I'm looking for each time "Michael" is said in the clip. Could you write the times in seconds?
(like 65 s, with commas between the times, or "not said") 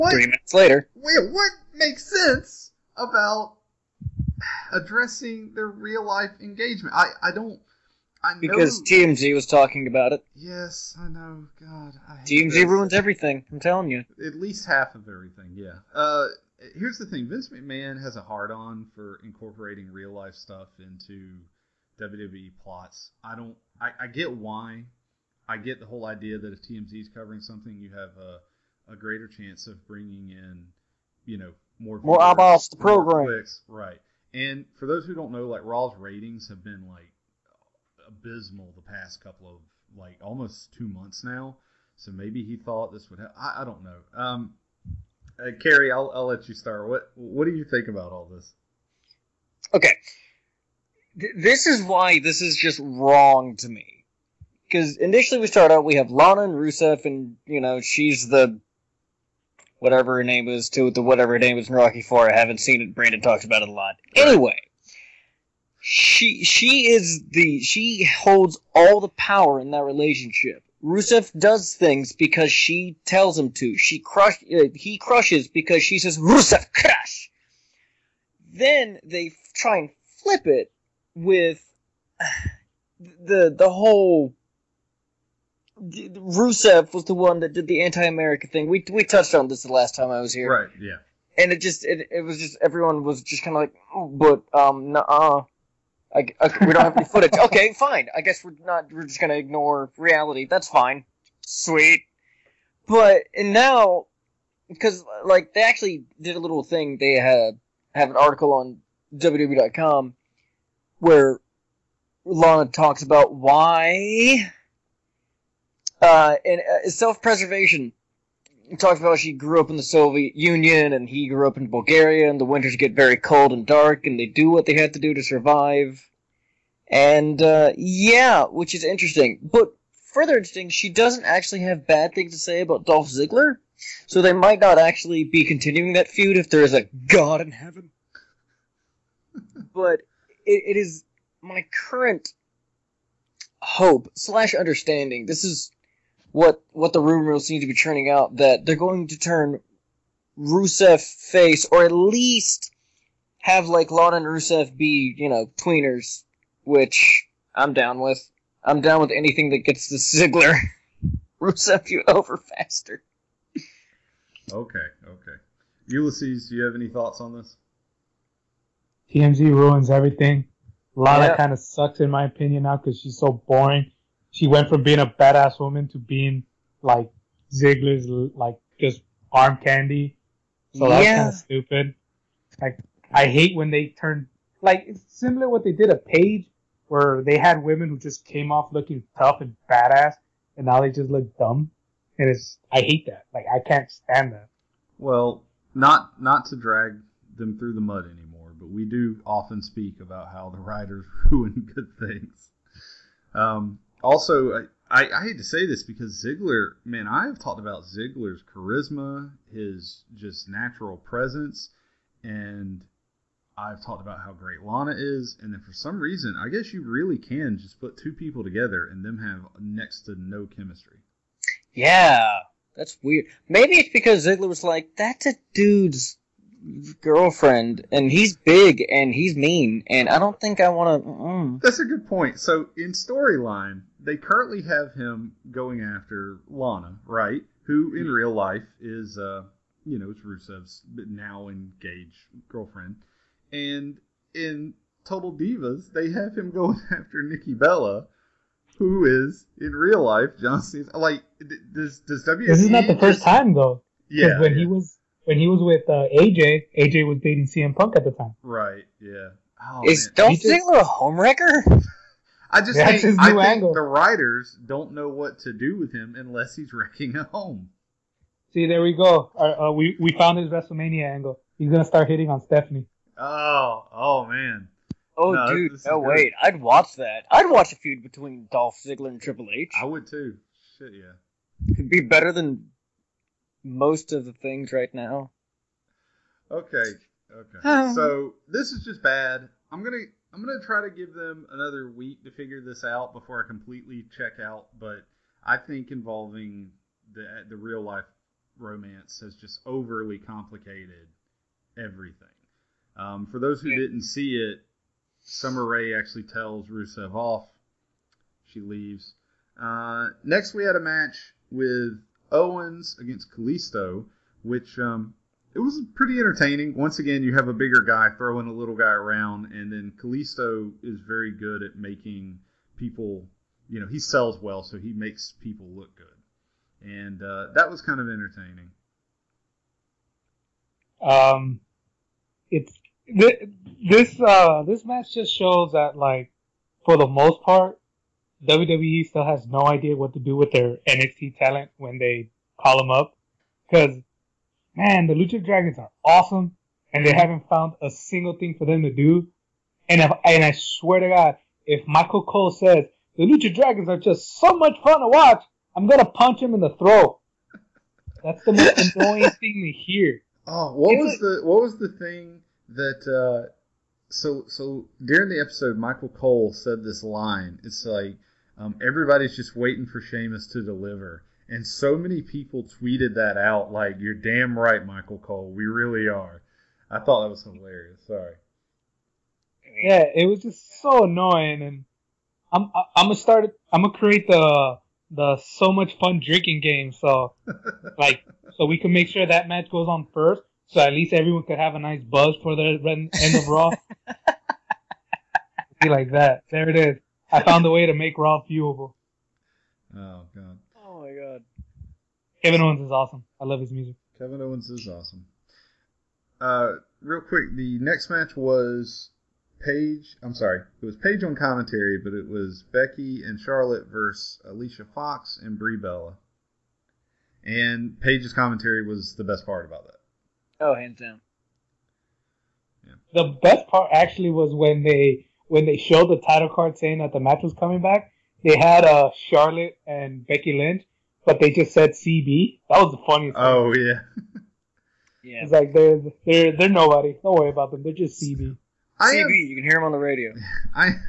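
351 s, 365 s, 374 s.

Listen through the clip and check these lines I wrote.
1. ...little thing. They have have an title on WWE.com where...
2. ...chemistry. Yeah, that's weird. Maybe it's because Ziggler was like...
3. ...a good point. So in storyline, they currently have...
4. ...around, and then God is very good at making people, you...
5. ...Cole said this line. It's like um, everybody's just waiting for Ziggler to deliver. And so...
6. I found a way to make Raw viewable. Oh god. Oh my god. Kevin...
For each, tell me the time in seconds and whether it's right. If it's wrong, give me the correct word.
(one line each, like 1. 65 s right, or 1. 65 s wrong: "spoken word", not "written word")
1. 106 s wrong: "article", not "title"
2. 220 s right
3. 231 s right
4. 318 s wrong: "Kalisto", not "God"
5. 366 s wrong: "Sheamus", not "Ziggler"
6. 397 s right.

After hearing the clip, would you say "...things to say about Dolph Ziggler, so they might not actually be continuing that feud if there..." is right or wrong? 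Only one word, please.
right.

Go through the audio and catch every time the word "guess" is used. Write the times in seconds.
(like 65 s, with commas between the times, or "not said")
98 s, 216 s.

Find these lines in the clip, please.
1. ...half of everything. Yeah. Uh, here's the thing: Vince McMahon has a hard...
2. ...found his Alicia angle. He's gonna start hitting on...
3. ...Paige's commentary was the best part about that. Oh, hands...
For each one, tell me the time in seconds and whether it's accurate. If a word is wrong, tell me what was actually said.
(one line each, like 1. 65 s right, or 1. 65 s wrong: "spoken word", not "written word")
1. 14 s right
2. 270 s wrong: "WrestleMania", not "Alicia"
3. 417 s right.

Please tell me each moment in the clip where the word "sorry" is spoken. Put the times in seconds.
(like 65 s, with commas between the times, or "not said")
378 s, 410 s.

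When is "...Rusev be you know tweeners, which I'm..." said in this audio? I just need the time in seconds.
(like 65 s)
154 s.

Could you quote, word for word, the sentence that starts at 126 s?
And uh, yeah, which is interesting.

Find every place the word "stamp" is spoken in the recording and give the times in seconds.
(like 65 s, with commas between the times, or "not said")
not said.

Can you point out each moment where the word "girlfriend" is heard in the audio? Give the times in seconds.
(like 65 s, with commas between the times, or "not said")
227 s, 242 s.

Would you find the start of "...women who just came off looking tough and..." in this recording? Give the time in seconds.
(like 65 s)
187 s.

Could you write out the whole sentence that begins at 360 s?
Oh, what it's was like, the what was the thing that?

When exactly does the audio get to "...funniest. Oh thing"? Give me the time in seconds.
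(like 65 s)
433 s.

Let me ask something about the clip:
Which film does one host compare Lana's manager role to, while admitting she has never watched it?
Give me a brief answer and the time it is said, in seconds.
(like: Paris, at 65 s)
Rocky Four, at 61 s.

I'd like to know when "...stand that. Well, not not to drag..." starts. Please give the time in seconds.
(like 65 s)
193 s.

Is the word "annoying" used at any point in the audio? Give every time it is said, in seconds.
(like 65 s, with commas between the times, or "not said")
358 s, 381 s.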